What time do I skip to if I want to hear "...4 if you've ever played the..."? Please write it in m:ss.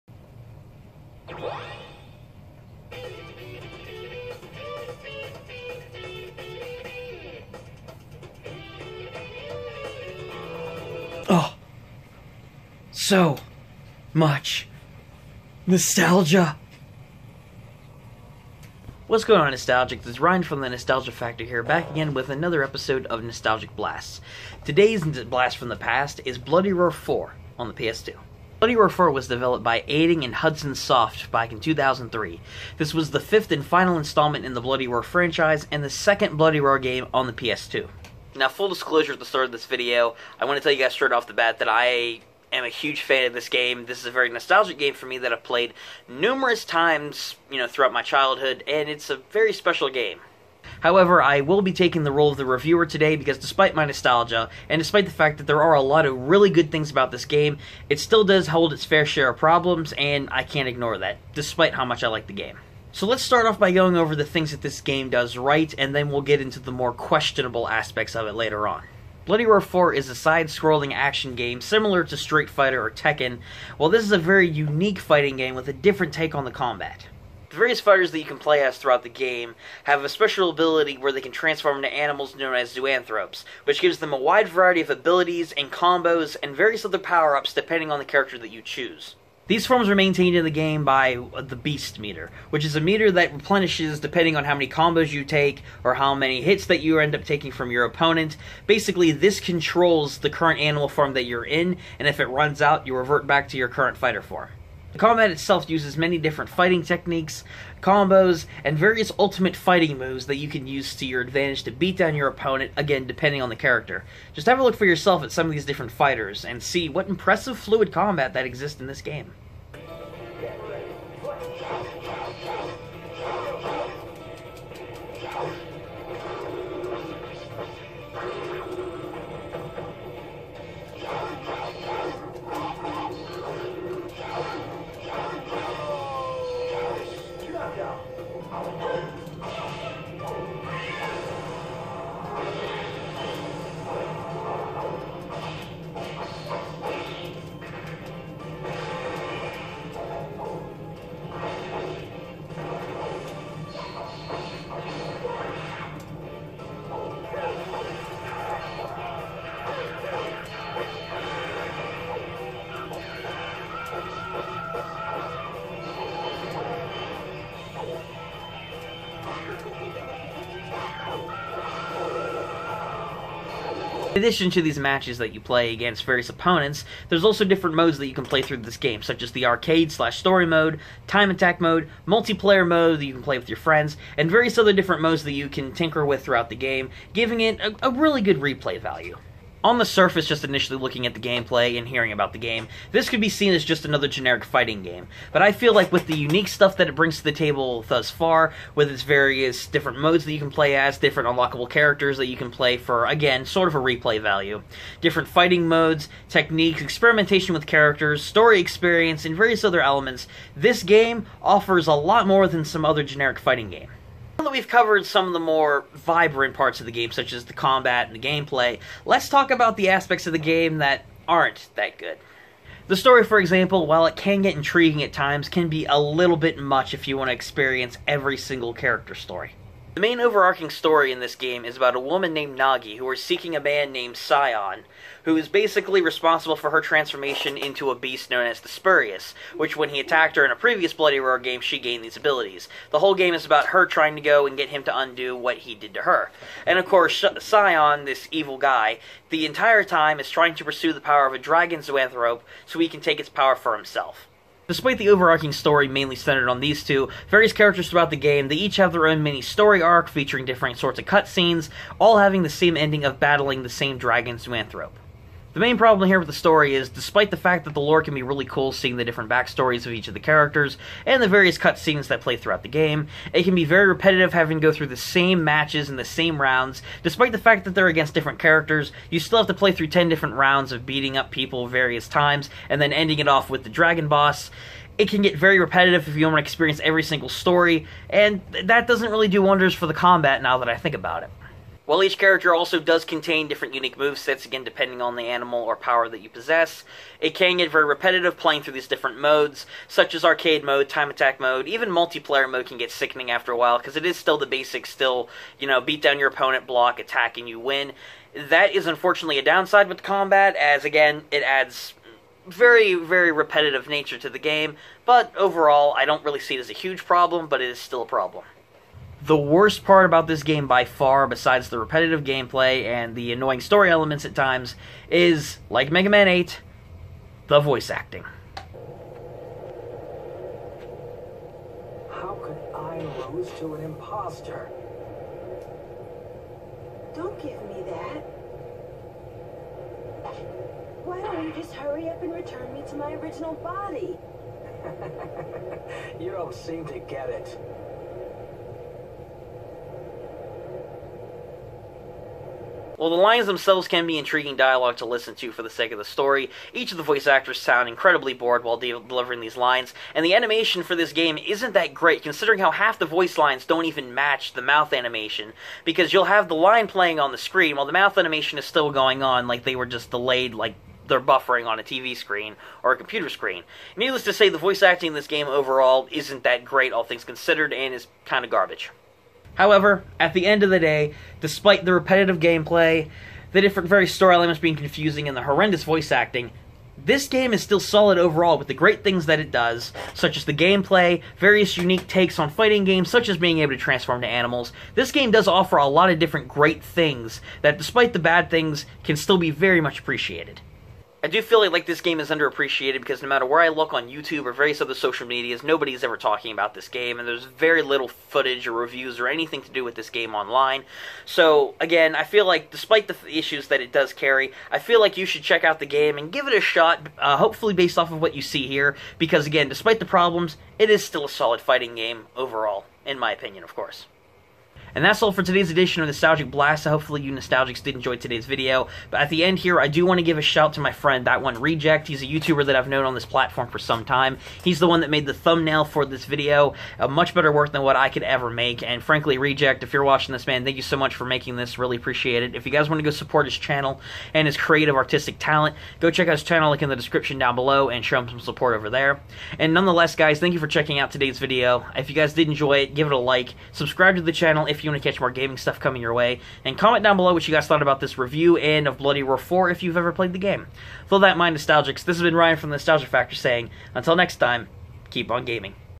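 7:39.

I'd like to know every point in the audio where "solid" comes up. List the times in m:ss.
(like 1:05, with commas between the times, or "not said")
6:27, 7:01.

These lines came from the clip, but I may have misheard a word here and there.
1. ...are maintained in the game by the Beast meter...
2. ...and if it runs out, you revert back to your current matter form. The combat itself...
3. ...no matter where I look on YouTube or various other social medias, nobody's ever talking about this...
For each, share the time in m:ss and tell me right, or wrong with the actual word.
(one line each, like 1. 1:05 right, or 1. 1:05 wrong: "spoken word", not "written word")
1. 1:29 right
2. 1:41 wrong: "fighter", not "matter"
3. 6:43 right.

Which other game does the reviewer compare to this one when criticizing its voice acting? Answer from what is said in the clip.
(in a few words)
Mega Man 8.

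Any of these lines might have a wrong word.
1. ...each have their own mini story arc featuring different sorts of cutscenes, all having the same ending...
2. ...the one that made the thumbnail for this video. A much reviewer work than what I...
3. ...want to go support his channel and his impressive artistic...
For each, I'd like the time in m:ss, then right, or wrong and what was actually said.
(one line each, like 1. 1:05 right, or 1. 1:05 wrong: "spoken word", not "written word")
1. 4:18 right
2. 7:14 wrong: "better", not "reviewer"
3. 7:22 wrong: "creative", not "impressive".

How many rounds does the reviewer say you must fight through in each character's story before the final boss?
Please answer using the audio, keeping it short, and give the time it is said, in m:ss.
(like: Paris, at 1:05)
10, at 4:39.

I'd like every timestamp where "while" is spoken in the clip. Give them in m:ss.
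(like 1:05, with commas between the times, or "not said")
1:13, 3:43, 4:51, 5:03, 5:53, 5:58, 6:07.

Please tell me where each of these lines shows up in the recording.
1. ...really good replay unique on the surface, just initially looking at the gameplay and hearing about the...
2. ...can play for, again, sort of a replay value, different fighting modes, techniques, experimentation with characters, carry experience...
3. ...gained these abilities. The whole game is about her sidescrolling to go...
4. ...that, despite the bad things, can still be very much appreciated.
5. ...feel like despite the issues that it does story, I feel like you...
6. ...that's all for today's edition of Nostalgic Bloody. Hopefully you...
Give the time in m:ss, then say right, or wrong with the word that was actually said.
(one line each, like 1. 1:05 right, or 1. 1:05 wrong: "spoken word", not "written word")
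1. 3:07 wrong: "value", not "unique"
2. 3:22 wrong: "story", not "carry"
3. 4:01 wrong: "trying", not "sidescrolling"
4. 6:37 right
5. 6:52 wrong: "carry", not "story"
6. 7:05 wrong: "Blast", not "Bloody".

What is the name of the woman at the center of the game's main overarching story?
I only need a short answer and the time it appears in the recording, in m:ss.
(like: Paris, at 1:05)
Nagi, at 3:52.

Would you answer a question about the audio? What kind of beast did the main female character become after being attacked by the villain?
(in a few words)
the Spurious.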